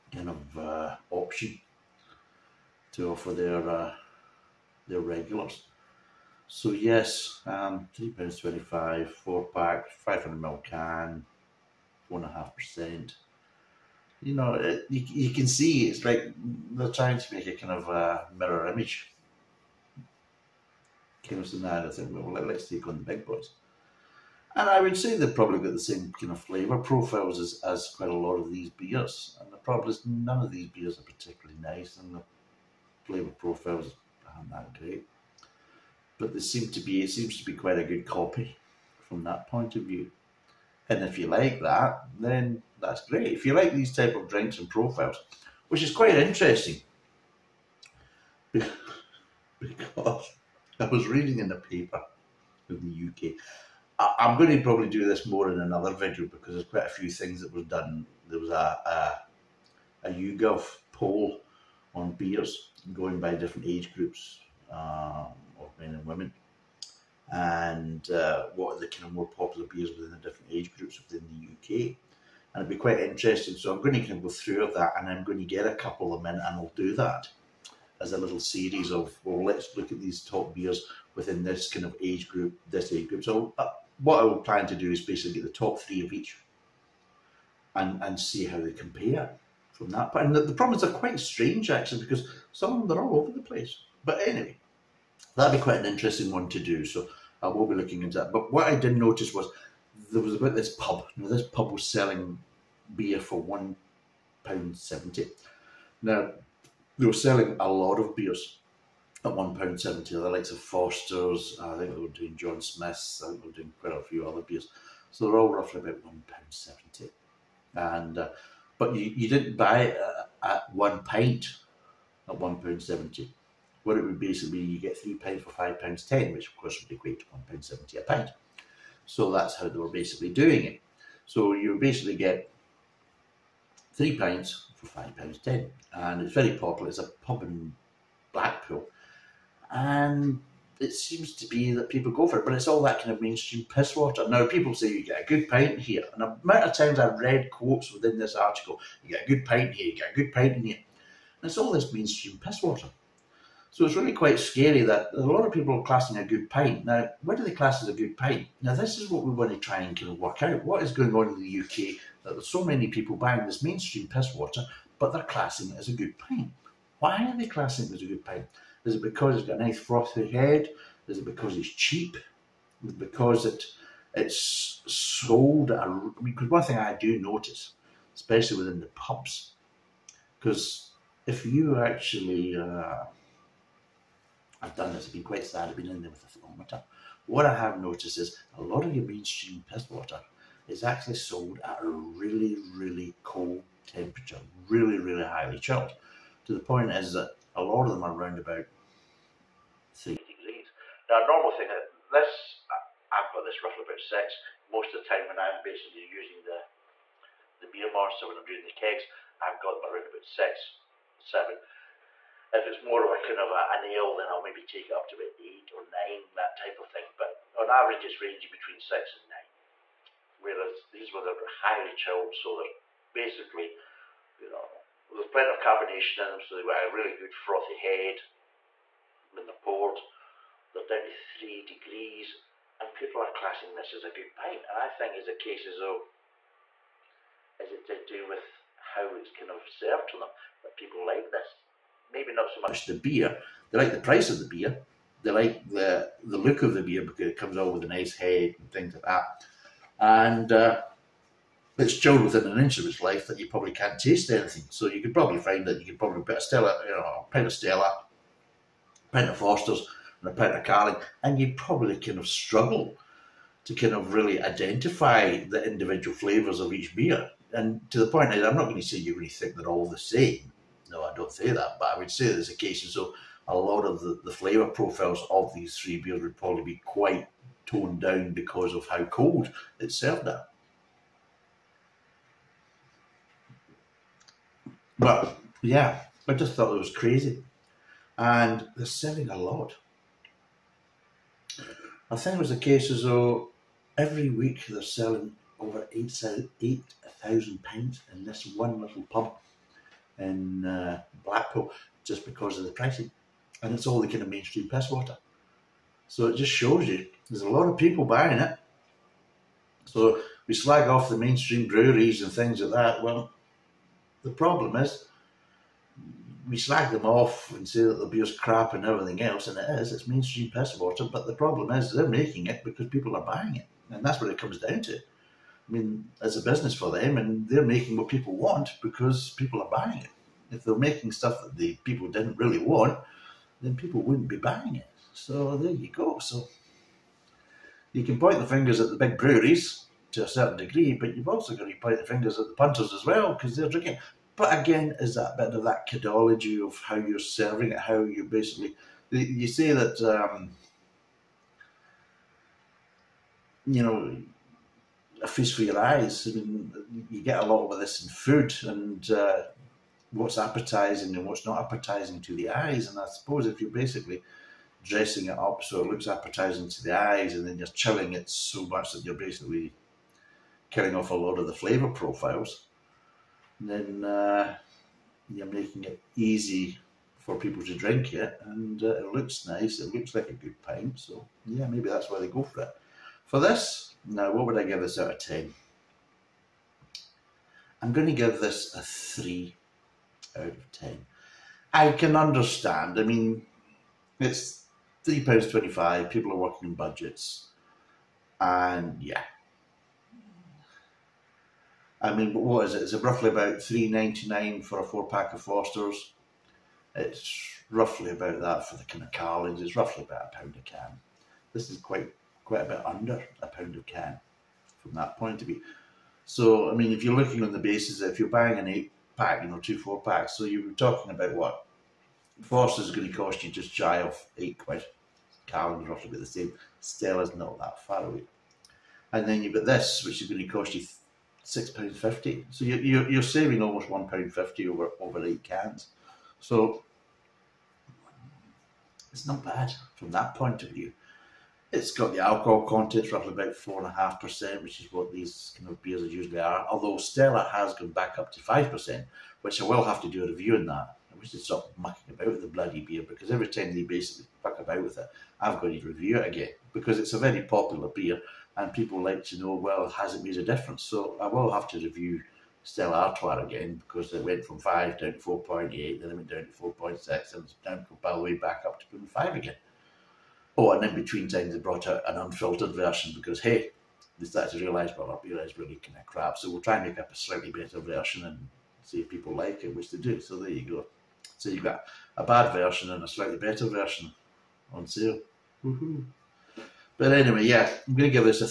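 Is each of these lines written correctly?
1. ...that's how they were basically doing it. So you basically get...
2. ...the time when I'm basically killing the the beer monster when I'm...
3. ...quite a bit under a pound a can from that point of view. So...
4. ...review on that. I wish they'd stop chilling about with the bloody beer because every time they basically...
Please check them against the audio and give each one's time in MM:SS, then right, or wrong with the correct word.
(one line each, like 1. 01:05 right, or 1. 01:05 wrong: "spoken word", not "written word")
1. 02:09 right
2. 03:24 wrong: "using", not "killing"
3. 06:52 right
4. 07:30 wrong: "mucking", not "chilling".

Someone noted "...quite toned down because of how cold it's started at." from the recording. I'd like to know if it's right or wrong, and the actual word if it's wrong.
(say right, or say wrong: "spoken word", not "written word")
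wrong: "served", not "started".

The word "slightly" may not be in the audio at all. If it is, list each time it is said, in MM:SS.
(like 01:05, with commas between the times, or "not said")
07:57, 08:03.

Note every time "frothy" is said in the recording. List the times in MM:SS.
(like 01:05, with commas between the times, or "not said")
02:49, 03:47.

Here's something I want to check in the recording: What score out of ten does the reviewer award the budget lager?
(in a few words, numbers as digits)
3.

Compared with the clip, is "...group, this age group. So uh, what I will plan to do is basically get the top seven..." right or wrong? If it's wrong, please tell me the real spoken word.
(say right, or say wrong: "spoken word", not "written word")
wrong: "three", not "seven".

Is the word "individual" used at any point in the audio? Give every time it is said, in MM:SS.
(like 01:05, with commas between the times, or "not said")
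04:25.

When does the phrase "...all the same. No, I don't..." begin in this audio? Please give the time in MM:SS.
04:29.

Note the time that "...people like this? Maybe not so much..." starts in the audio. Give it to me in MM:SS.
04:00.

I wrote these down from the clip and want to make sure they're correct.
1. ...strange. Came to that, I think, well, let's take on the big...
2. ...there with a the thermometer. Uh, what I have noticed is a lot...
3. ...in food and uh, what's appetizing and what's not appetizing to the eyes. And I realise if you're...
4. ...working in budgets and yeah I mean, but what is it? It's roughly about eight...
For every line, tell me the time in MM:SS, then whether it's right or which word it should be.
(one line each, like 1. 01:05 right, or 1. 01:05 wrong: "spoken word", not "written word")
1. 00:18 wrong: "image", not "strange"
2. 03:06 right
3. 05:58 wrong: "suppose", not "realise"
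4. 06:36 wrong: "three", not "eight".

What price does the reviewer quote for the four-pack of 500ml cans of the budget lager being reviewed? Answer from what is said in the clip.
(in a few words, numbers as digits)
£3.25.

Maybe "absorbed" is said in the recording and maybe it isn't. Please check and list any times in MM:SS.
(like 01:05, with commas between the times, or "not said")
not said.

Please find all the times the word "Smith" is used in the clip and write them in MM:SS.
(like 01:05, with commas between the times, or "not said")
01:52.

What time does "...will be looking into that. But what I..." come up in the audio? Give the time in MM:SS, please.
01:37.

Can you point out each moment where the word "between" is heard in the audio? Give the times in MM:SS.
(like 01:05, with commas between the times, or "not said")
03:38, 07:50.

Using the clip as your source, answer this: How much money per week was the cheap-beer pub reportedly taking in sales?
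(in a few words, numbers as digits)
over £8,000.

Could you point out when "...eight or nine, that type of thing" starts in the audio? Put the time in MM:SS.
03:35.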